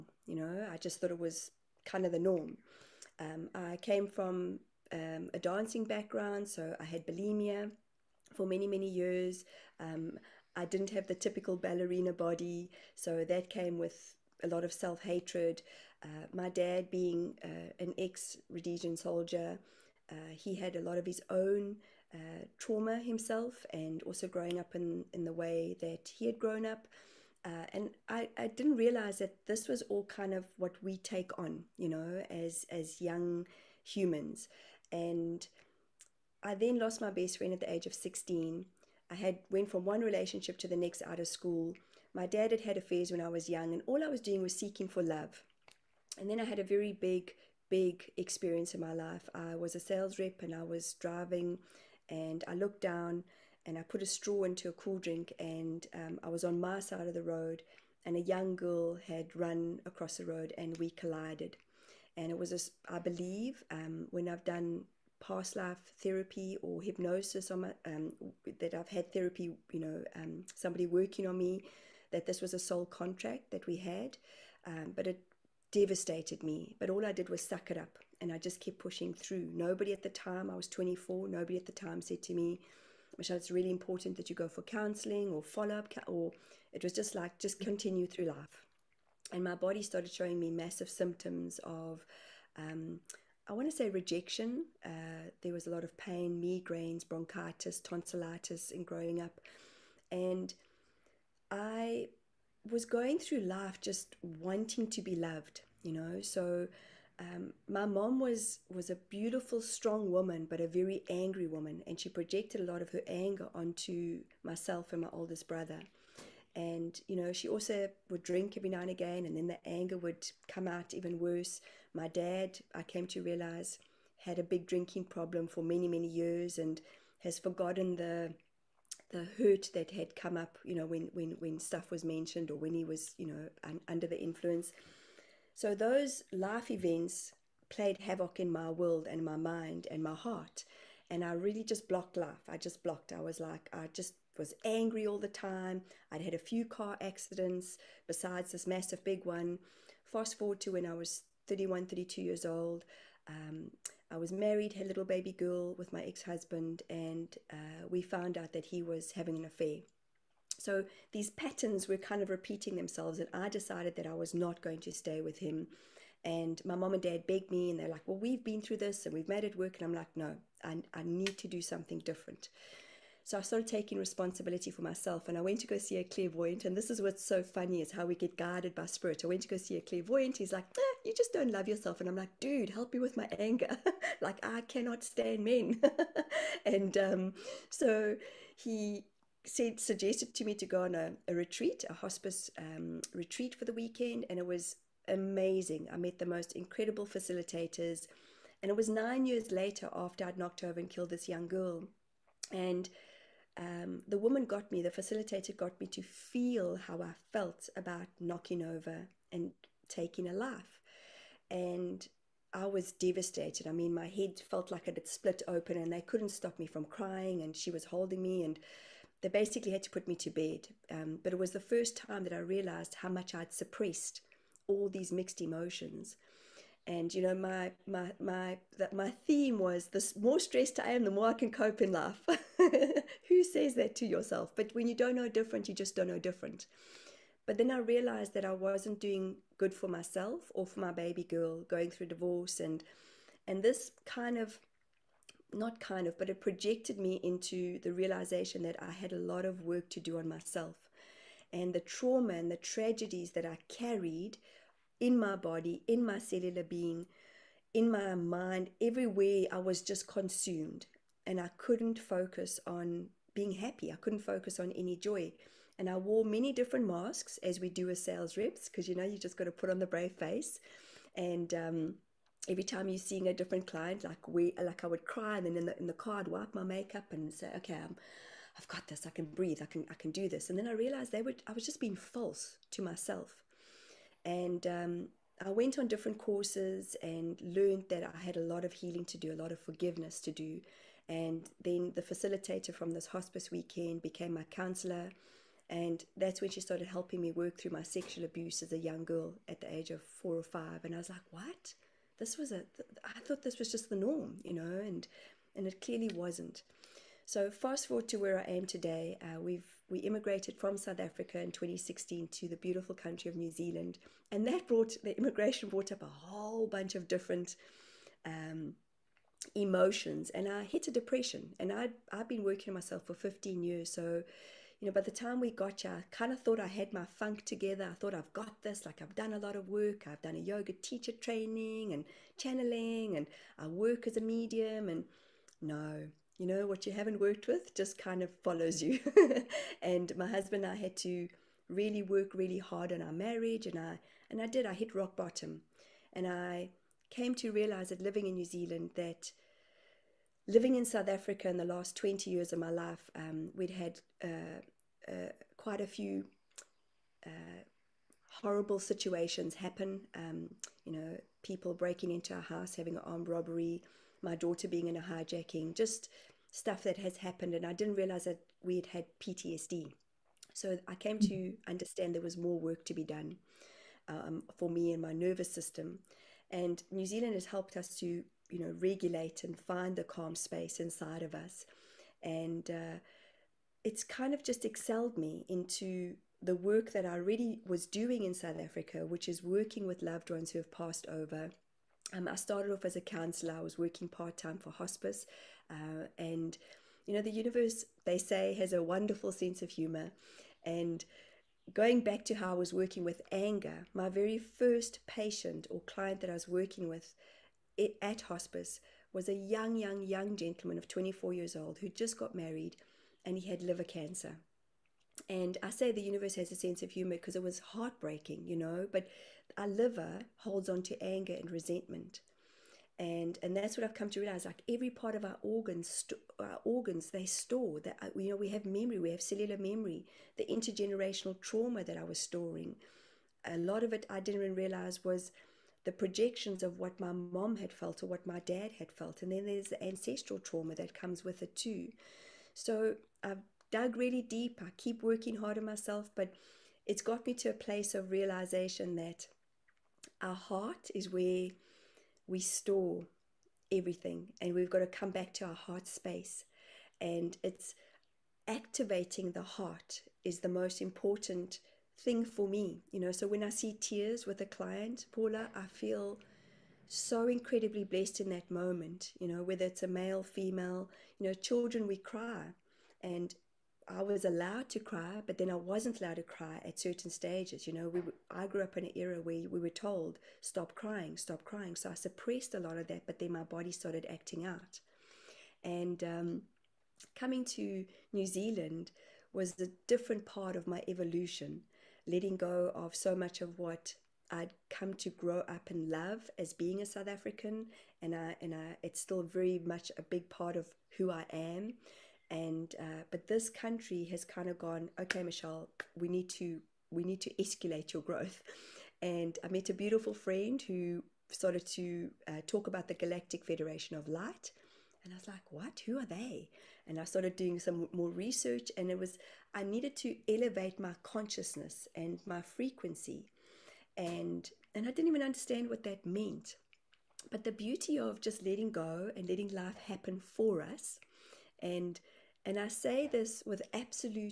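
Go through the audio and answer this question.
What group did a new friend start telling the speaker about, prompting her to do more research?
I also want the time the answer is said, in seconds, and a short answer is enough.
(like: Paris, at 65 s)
Galactic Federation of Light, at 512 s.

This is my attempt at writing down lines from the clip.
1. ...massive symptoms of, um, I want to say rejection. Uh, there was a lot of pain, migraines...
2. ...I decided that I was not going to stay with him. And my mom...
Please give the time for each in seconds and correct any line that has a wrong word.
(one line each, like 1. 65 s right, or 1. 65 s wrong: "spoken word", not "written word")
1. 90 s right
2. 163 s right.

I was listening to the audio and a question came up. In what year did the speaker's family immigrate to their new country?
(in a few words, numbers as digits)
2016.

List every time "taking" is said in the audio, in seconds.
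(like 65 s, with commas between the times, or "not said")
173 s, 209 s.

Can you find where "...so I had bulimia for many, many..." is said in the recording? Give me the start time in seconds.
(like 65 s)
6 s.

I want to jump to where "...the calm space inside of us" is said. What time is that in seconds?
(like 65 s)
379 s.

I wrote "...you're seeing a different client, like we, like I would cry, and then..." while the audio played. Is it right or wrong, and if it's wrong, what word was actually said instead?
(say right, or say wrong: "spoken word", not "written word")
right.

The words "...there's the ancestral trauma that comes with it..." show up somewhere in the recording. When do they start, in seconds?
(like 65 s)
439 s.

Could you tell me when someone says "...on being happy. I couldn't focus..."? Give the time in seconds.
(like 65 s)
262 s.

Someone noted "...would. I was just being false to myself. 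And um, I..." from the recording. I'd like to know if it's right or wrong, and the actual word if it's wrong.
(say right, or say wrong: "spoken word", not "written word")
right.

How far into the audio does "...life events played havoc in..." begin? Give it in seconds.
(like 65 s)
136 s.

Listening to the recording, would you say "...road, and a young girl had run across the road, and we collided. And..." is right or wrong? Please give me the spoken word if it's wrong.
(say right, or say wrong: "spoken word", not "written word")
right.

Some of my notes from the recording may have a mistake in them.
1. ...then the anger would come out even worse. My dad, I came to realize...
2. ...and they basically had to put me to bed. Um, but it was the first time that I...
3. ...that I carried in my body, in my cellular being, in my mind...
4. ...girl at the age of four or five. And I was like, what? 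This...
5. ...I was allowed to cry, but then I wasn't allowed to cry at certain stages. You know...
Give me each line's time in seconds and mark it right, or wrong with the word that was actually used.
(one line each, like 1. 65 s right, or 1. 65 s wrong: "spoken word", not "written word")
1. 119 s right
2. 218 s right
3. 253 s right
4. 299 s right
5. 473 s right.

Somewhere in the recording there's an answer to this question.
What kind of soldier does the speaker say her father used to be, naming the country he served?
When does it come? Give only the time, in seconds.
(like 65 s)
18 s.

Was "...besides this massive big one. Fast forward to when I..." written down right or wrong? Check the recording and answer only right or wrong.
right.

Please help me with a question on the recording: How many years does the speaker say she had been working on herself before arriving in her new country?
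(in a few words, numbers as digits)
15.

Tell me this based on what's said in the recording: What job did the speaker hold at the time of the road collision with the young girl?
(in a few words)
Sales rep.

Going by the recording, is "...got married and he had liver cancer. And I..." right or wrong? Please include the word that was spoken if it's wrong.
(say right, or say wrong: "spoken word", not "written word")
right.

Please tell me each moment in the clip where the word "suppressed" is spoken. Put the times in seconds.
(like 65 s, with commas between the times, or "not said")
223 s, 481 s.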